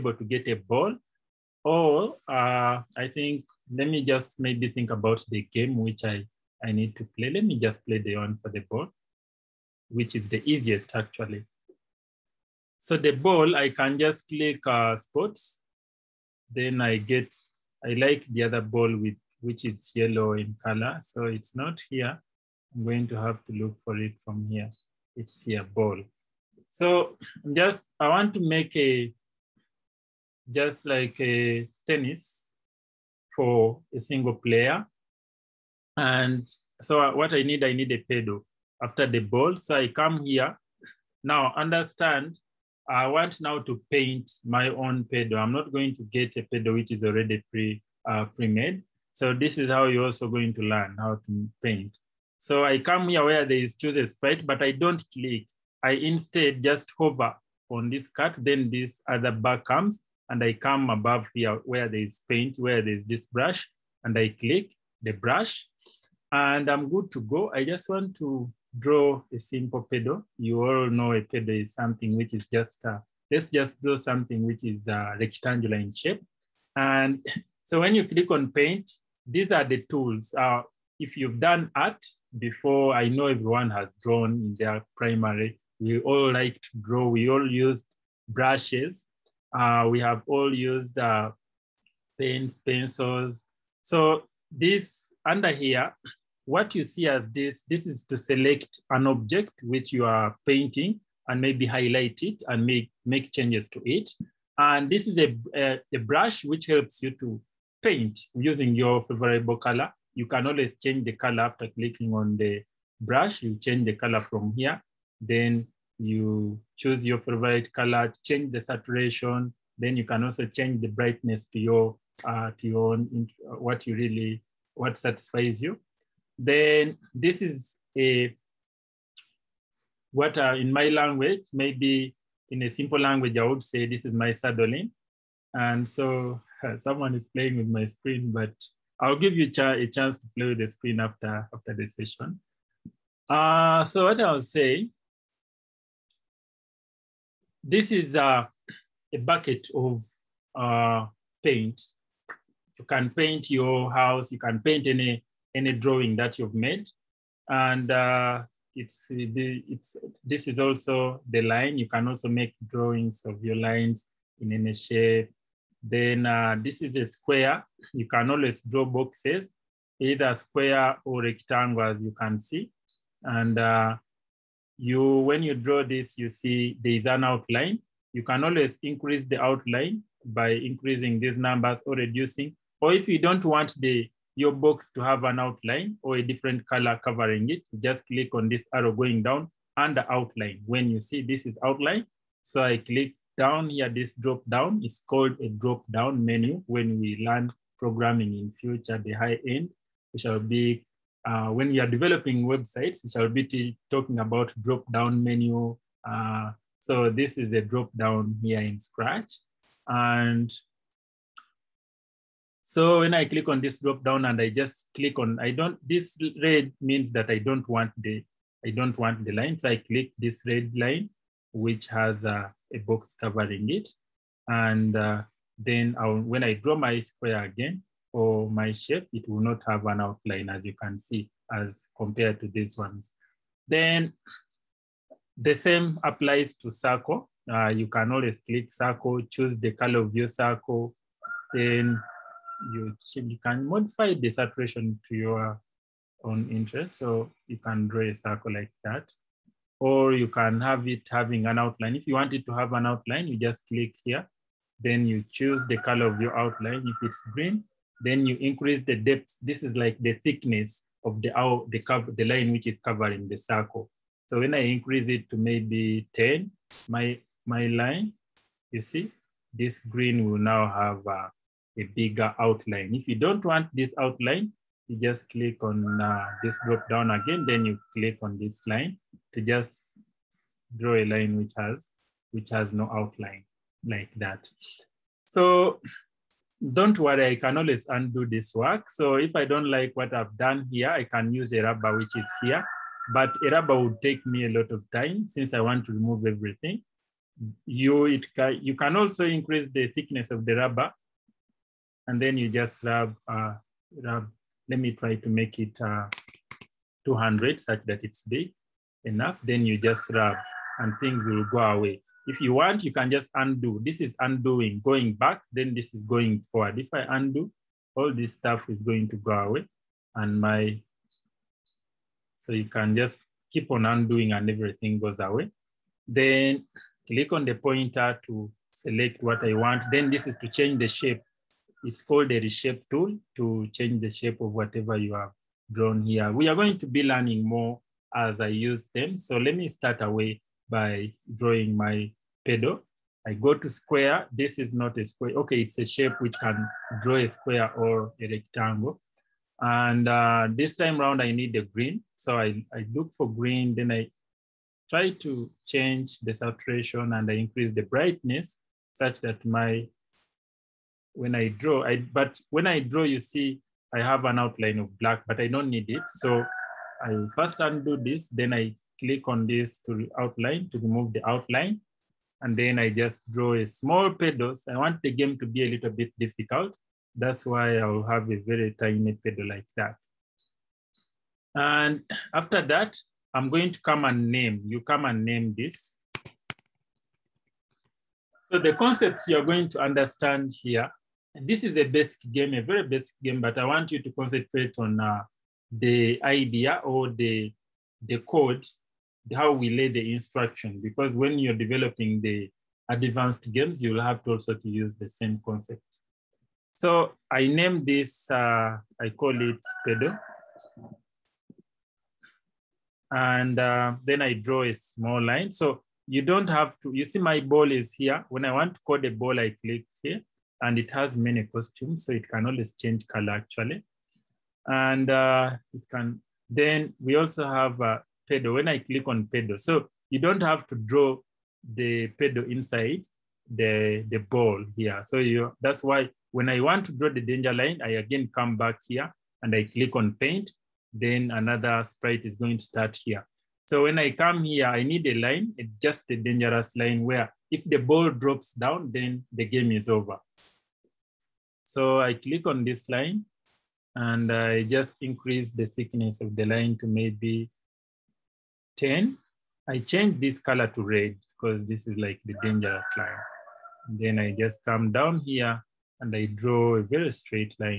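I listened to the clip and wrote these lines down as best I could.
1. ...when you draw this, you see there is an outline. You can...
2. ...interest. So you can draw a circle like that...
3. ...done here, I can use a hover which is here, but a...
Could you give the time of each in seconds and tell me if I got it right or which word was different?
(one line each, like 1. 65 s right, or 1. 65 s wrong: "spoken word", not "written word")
1. 175 s right
2. 246 s right
3. 290 s wrong: "rubber", not "hover".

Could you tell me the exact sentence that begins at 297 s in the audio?
You, it can, you can also increase the thickness of the rubber and then you just rub, uh, rub.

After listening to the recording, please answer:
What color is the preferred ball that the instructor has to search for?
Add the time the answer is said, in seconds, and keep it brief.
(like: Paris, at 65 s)
Yellow, at 19 s.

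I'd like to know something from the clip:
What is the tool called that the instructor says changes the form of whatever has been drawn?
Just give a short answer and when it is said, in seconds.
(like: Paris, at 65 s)
Reshape tool, at 332 s.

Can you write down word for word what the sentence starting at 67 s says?
I just want to draw a simple pedo.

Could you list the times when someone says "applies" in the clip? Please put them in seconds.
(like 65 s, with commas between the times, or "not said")
236 s.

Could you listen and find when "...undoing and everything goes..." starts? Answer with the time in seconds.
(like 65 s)
323 s.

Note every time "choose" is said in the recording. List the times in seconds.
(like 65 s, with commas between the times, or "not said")
53 s, 116 s, 239 s, 255 s.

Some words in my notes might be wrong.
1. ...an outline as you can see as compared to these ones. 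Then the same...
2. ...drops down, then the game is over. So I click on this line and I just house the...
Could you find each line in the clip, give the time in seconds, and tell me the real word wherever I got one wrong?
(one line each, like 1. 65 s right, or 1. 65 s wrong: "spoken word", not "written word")
1. 229 s right
2. 448 s wrong: "increase", not "house".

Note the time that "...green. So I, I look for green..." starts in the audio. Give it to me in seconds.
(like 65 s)
351 s.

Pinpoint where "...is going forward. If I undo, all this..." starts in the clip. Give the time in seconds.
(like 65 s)
315 s.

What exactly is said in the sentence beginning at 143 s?
Uh, so what I'll say this is a, uh, a bucket of uh, paint.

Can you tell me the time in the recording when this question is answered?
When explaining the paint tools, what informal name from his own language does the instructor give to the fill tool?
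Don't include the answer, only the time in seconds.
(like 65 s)
134 s.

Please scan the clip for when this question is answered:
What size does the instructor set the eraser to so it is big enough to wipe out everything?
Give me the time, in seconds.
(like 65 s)
307 s.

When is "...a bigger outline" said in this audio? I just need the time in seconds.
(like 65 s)
271 s.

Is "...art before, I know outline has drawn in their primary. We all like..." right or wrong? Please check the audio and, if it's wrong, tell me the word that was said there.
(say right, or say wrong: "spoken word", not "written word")
wrong: "everyone", not "outline".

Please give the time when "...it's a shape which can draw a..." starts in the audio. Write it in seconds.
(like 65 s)
345 s.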